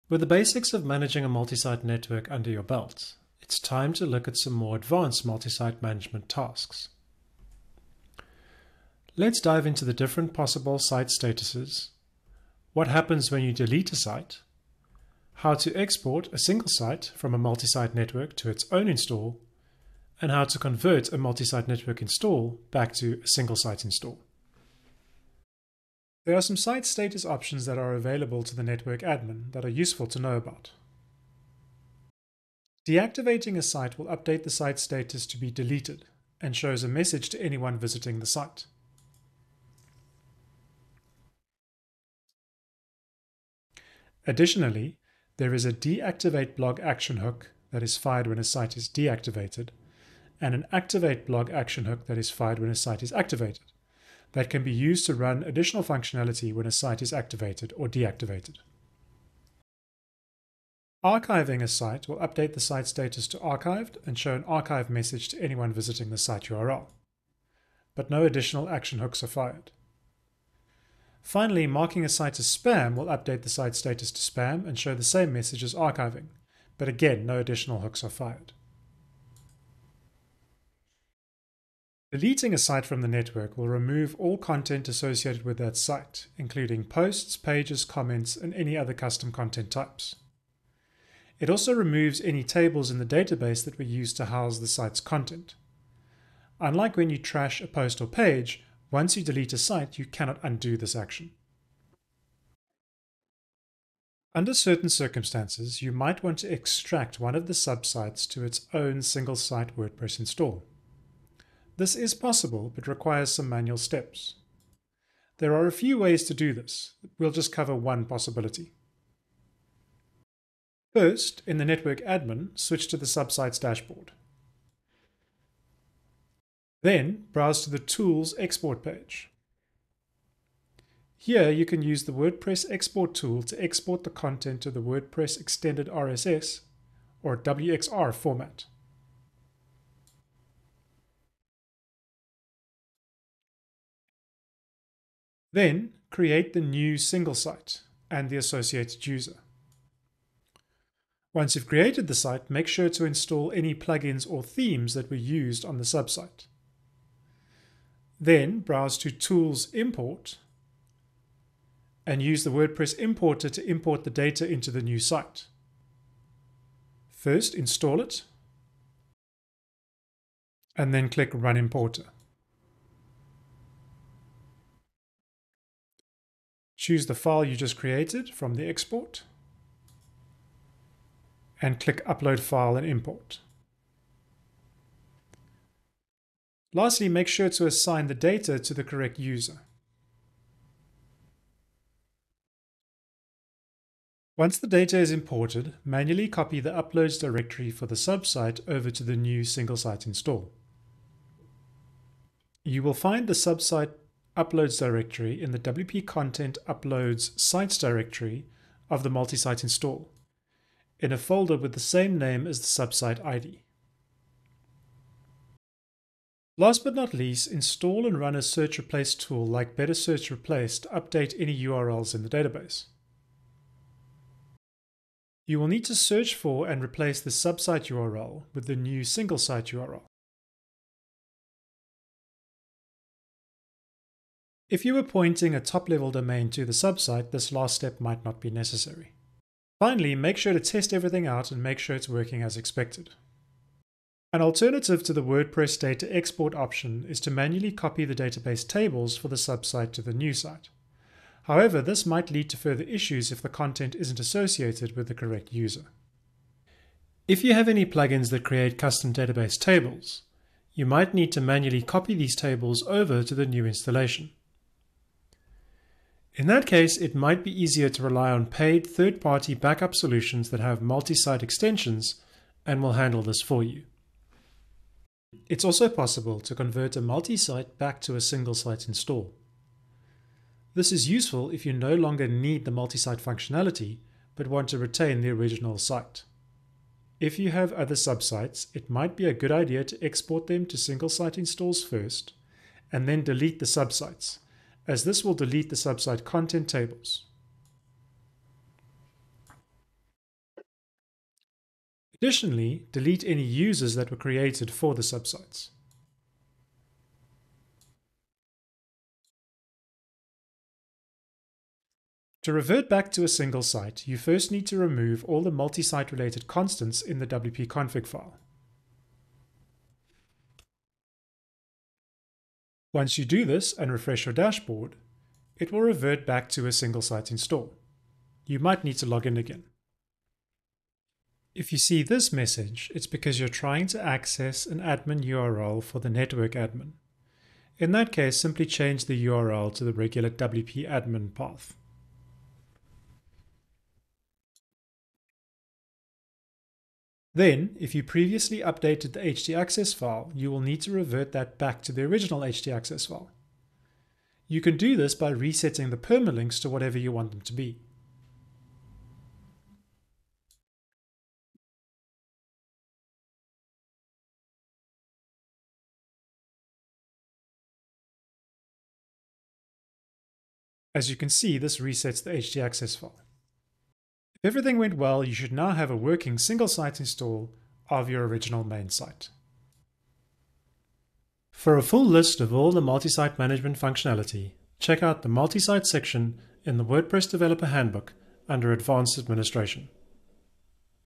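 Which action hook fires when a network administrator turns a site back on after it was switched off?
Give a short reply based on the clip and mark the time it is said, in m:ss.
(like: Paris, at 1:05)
activate blog, at 0:50.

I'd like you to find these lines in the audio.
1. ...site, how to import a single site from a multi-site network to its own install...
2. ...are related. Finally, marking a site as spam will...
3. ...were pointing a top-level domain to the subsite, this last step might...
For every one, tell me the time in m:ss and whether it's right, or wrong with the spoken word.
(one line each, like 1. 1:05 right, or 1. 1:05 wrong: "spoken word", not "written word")
1. 0:13 wrong: "export", not "import"
2. 1:09 wrong: "fired", not "related"
3. 3:54 right.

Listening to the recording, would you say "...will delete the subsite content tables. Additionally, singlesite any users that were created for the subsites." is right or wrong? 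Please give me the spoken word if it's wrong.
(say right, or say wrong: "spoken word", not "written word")
wrong: "delete", not "singlesite".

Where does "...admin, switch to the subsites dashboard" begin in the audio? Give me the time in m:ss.
2:02.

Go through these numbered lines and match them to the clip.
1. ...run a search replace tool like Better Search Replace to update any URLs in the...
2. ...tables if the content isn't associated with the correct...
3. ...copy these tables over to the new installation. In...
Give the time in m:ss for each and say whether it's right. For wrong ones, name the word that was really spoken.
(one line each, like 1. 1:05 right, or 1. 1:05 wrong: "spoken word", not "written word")
1. 3:38 right
2. 4:12 wrong: "issues", not "tables"
3. 4:21 right.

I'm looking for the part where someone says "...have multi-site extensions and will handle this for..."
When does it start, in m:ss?
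4:30.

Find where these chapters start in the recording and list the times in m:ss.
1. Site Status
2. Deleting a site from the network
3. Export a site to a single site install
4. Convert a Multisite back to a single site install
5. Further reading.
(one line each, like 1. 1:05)
1. 0:25
2. 1:21
3. 1:42
4. 4:35
5. 6:21.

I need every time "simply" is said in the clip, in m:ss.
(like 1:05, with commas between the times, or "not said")
5:38.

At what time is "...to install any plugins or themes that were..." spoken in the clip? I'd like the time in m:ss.
2:32.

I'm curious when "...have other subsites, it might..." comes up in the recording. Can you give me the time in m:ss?
4:47.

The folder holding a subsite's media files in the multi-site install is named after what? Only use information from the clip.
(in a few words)
the subsite ID.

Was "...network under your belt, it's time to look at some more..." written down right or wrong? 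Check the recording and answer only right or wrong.
right.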